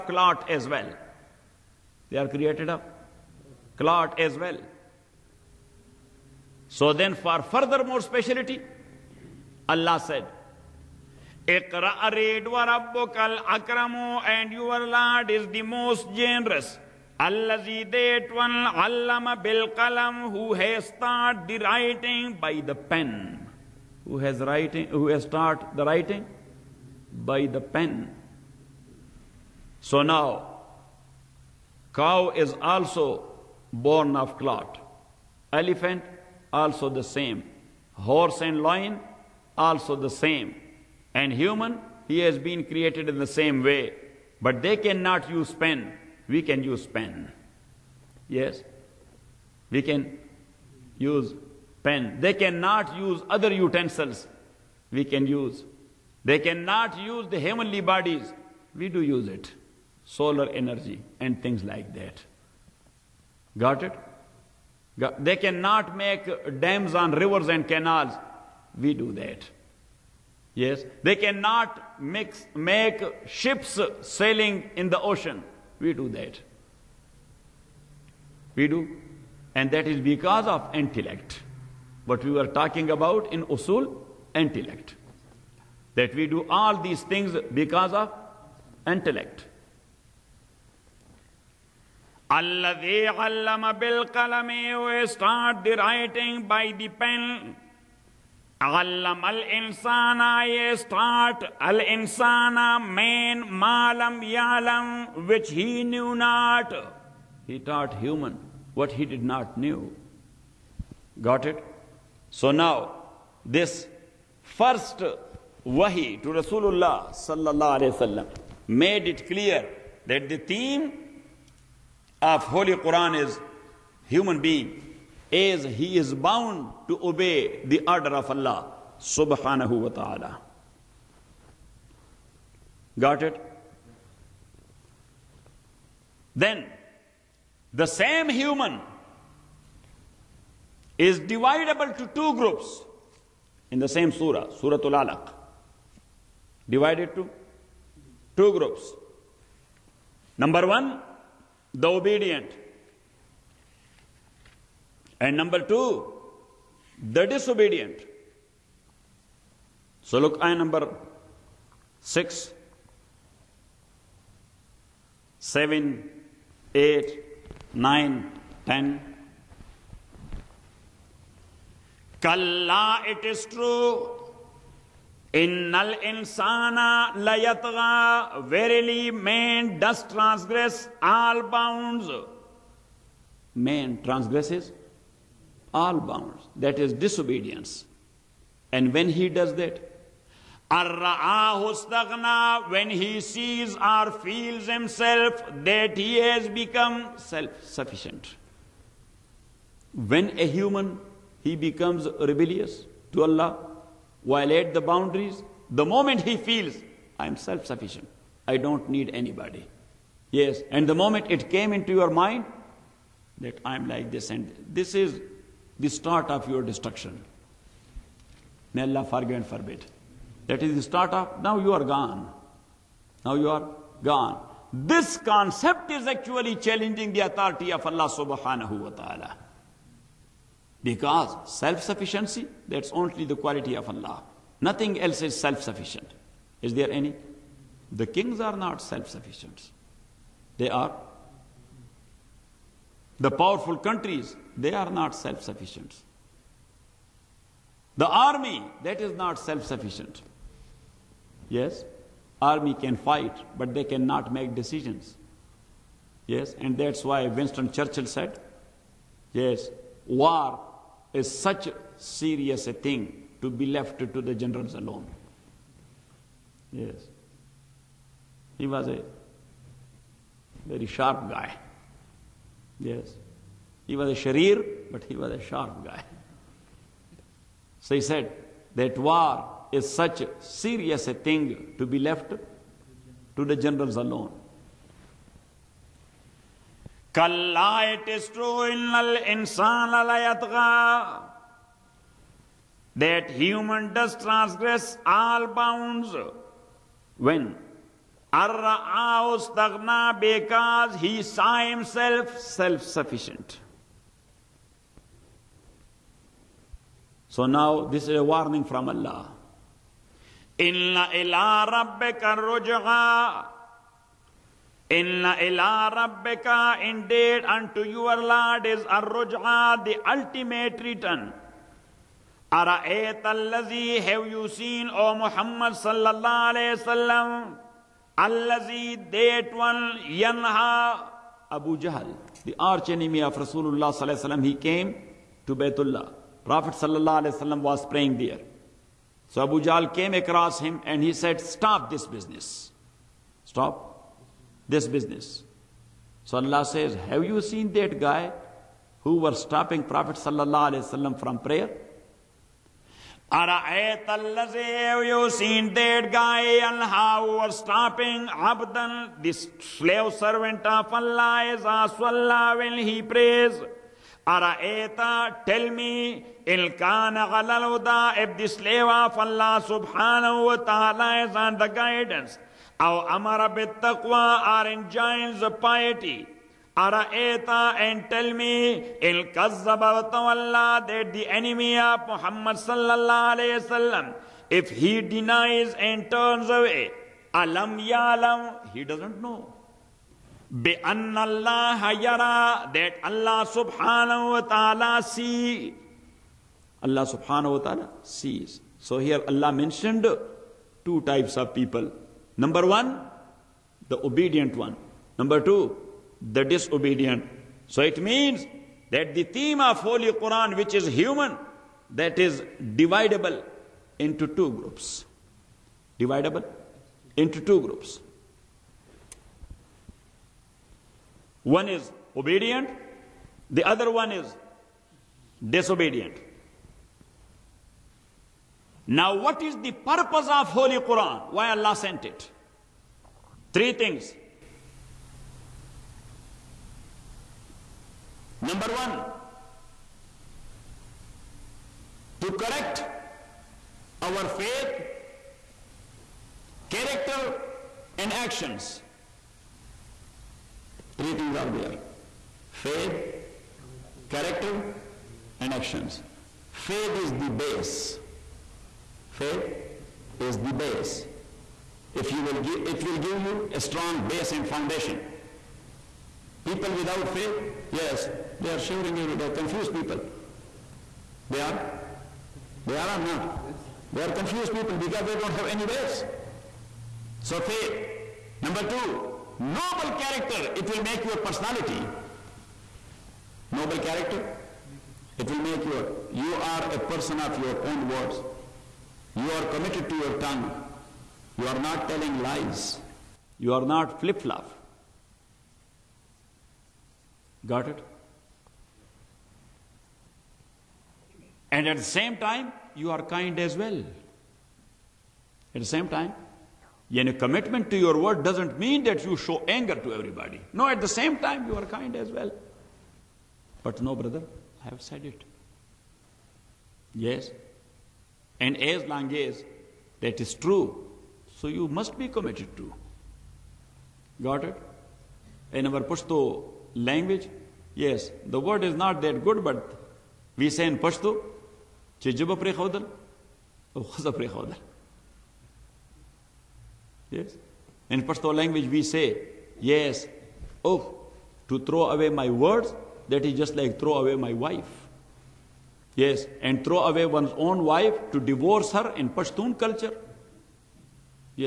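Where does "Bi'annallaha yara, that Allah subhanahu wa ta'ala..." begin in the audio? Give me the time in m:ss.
6:30.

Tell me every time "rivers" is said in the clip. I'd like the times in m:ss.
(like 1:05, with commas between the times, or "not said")
1:07.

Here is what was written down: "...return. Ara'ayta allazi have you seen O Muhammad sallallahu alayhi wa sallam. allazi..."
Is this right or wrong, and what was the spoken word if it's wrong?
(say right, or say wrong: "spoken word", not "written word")
right.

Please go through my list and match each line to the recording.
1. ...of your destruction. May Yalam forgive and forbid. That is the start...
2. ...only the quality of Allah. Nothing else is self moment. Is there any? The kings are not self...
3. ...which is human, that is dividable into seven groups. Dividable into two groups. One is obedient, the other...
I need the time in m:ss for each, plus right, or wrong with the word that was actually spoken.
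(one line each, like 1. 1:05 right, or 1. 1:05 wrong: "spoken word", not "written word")
1. 3:36 wrong: "Allah", not "Yalam"
2. 3:52 wrong: "sufficient", not "moment"
3. 6:50 wrong: "two", not "seven".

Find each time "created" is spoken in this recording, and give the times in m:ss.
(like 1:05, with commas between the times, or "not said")
0:02, 0:42.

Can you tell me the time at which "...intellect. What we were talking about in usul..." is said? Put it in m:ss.
1:20.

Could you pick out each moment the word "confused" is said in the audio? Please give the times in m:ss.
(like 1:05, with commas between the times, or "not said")
7:49, 7:54.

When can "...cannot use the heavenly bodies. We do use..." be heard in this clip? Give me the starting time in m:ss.
0:56.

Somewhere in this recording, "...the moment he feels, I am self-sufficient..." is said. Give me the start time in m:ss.
3:25.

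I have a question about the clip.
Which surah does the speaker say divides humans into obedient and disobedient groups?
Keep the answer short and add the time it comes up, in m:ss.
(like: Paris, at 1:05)
Surah Alaq, at 2:24.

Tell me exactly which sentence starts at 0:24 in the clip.
Who has writing who has started the writing?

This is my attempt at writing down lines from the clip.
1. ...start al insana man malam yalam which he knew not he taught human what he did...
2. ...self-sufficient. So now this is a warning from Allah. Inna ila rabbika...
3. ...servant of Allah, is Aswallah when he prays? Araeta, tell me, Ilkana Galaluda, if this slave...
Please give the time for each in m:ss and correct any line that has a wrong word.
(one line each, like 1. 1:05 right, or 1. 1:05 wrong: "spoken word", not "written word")
1. 1:40 right
2. 5:02 right
3. 6:00 right.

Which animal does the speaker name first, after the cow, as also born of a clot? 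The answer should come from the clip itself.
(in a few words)
Elephant.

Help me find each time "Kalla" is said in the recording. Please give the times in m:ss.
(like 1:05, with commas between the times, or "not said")
2:52, 4:47.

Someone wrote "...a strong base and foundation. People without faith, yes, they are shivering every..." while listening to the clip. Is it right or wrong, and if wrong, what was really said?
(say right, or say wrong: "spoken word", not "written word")
right.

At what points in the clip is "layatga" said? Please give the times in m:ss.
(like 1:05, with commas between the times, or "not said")
2:57.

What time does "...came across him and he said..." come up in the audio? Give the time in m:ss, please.
5:39.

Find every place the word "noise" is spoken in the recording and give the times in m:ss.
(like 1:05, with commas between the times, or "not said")
not said.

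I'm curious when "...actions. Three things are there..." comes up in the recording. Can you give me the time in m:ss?
7:28.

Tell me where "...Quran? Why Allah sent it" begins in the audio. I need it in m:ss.
7:10.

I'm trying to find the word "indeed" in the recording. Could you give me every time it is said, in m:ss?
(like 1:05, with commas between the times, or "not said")
5:16.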